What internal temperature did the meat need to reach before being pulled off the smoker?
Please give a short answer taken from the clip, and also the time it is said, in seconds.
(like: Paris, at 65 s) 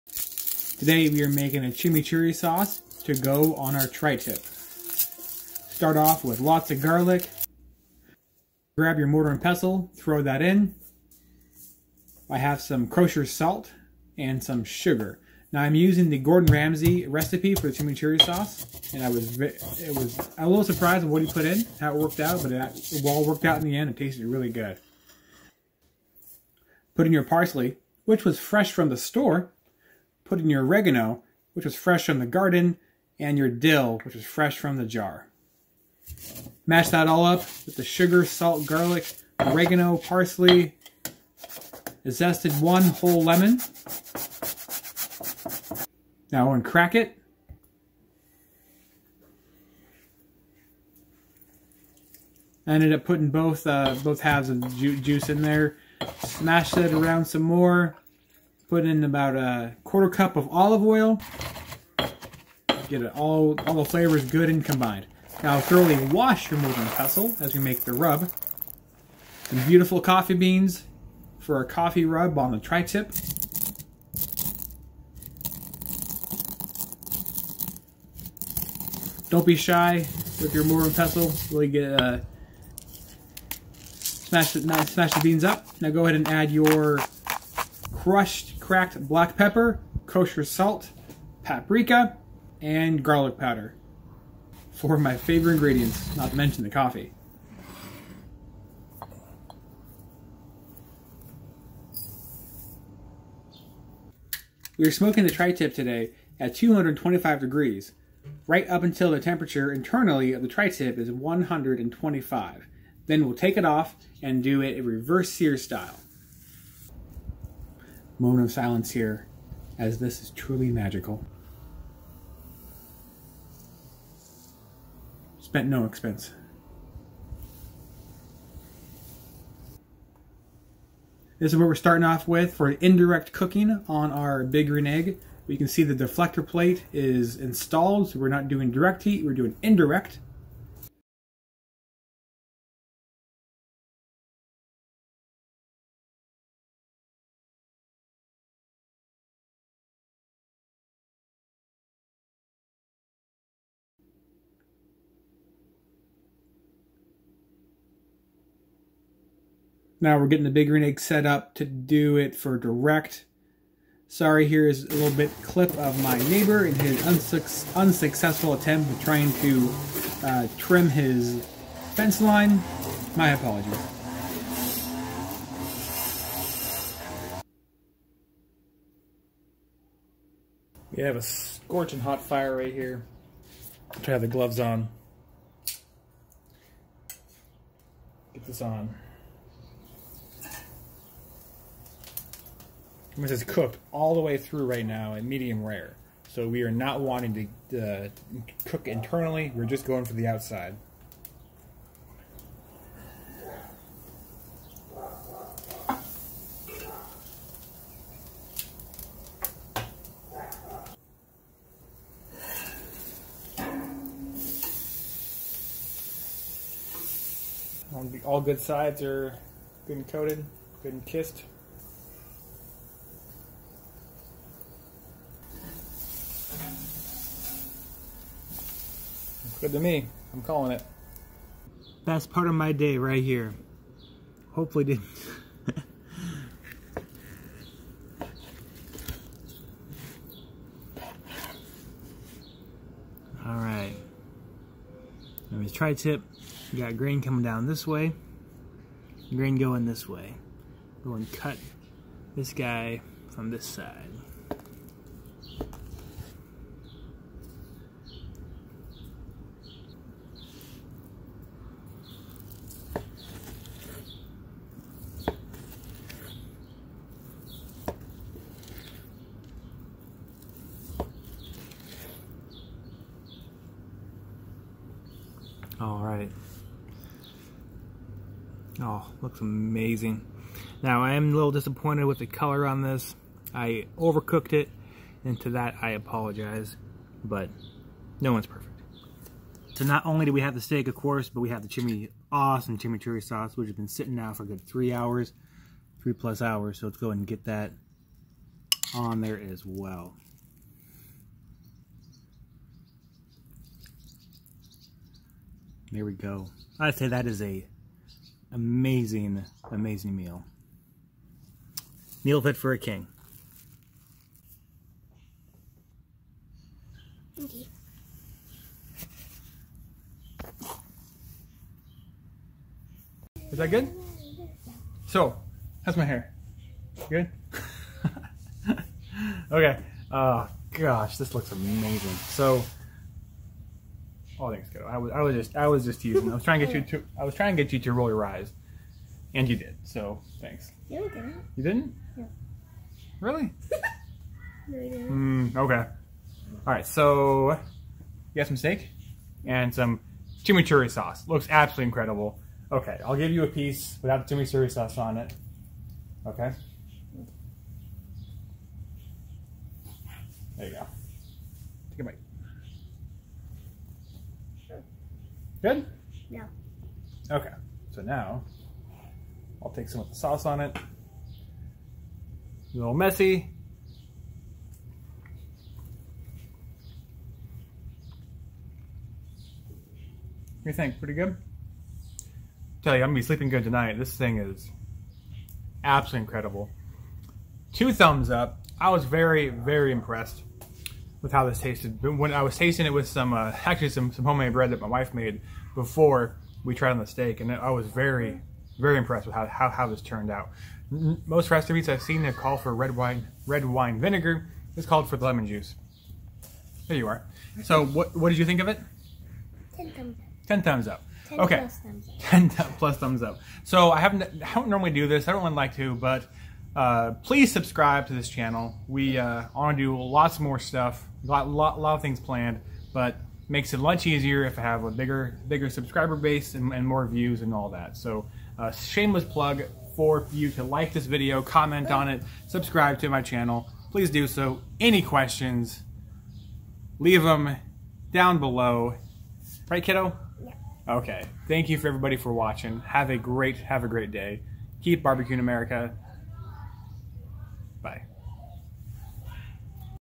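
125, at 111 s.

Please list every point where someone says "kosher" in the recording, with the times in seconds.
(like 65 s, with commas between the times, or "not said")
12 s, 90 s.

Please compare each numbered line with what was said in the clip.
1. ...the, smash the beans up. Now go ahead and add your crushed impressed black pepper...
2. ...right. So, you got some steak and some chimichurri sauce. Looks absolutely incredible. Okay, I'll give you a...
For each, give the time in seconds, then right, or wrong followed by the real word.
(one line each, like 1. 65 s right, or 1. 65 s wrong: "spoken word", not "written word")
1. 84 s wrong: "cracked", not "impressed"
2. 346 s right.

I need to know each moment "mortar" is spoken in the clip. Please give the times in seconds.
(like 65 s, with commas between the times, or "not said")
9 s, 66 s.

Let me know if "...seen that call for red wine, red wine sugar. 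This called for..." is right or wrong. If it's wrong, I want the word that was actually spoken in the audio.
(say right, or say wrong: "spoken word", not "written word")
wrong: "vinegar", not "sugar".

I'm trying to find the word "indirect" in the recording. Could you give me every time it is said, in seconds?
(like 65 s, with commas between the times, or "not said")
132 s, 139 s.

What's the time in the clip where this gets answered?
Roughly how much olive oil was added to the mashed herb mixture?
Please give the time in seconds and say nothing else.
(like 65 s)
59 s.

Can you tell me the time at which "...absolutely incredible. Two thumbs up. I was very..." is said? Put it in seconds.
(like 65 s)
385 s.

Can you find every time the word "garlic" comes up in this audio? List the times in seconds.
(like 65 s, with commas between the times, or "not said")
6 s, 38 s, 93 s.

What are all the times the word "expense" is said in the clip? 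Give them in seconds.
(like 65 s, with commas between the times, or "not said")
125 s.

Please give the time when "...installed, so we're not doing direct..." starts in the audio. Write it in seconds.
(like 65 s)
137 s.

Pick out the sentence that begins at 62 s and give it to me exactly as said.
Get it all, all the flavors good and combined.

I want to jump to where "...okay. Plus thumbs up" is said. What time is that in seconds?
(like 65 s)
411 s.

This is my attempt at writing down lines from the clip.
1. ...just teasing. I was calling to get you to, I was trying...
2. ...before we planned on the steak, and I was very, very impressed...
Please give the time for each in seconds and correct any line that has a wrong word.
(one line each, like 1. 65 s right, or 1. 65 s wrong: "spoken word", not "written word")
1. 335 s wrong: "trying", not "calling"
2. 395 s wrong: "tried", not "planned".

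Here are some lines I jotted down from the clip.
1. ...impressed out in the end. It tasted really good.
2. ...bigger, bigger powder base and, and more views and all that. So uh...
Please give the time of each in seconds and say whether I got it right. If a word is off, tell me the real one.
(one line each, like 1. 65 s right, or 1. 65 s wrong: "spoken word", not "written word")
1. 23 s wrong: "worked", not "impressed"
2. 424 s wrong: "subscriber", not "powder".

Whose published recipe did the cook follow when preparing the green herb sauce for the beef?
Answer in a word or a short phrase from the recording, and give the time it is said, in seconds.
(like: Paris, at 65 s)
Gordon Ramsay, at 16 s.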